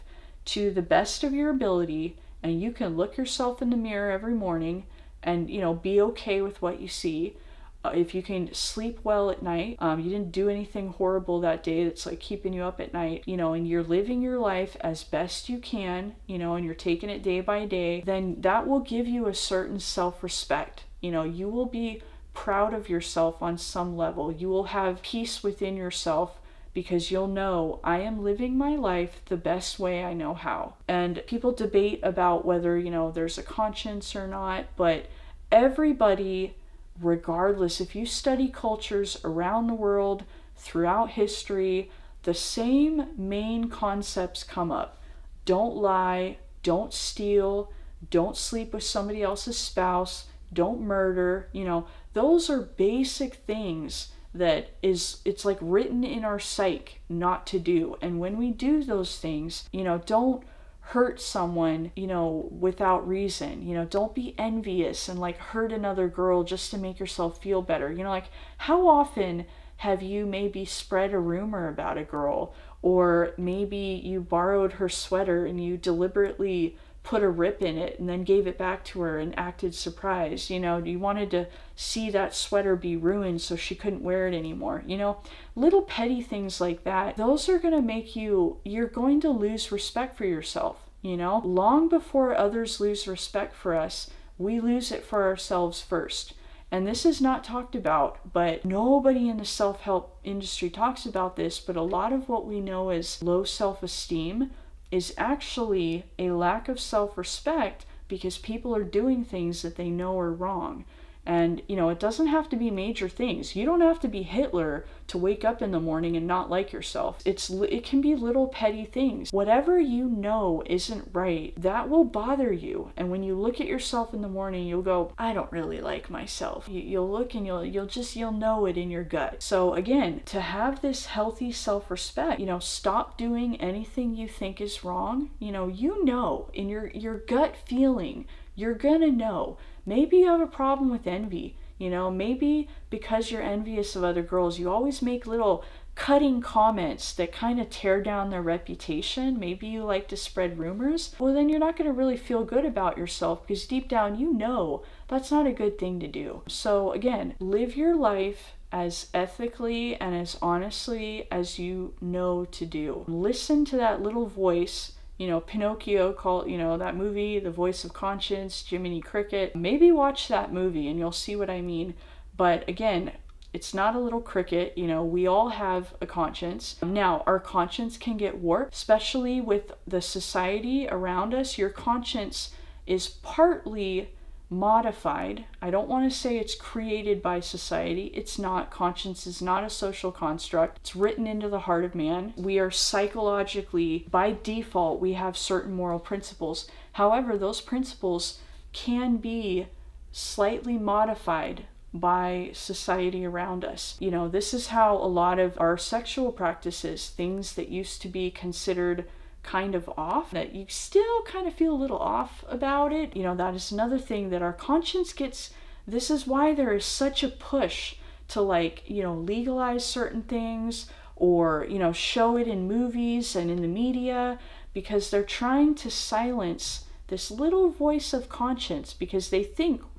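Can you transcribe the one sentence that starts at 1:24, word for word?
You know, little petty things like that, those are going to make you, you're going to lose respect for yourself.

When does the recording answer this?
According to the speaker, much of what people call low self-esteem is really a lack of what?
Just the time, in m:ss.
1:46.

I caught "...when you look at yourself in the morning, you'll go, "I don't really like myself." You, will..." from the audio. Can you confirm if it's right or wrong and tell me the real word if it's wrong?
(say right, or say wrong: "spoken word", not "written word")
right.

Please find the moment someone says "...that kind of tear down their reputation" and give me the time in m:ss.
2:27.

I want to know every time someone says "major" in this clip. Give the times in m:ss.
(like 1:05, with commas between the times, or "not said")
1:52.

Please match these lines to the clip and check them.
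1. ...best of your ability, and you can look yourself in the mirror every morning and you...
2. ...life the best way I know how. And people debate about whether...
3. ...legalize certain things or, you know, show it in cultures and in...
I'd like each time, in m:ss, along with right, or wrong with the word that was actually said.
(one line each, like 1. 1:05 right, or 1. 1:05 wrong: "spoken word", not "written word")
1. 0:00 right
2. 0:28 right
3. 3:39 wrong: "movies", not "cultures".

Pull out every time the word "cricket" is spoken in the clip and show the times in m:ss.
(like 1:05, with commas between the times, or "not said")
2:49, 2:54.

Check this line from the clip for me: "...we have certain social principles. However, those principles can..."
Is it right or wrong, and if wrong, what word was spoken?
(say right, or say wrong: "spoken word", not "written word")
wrong: "moral", not "social".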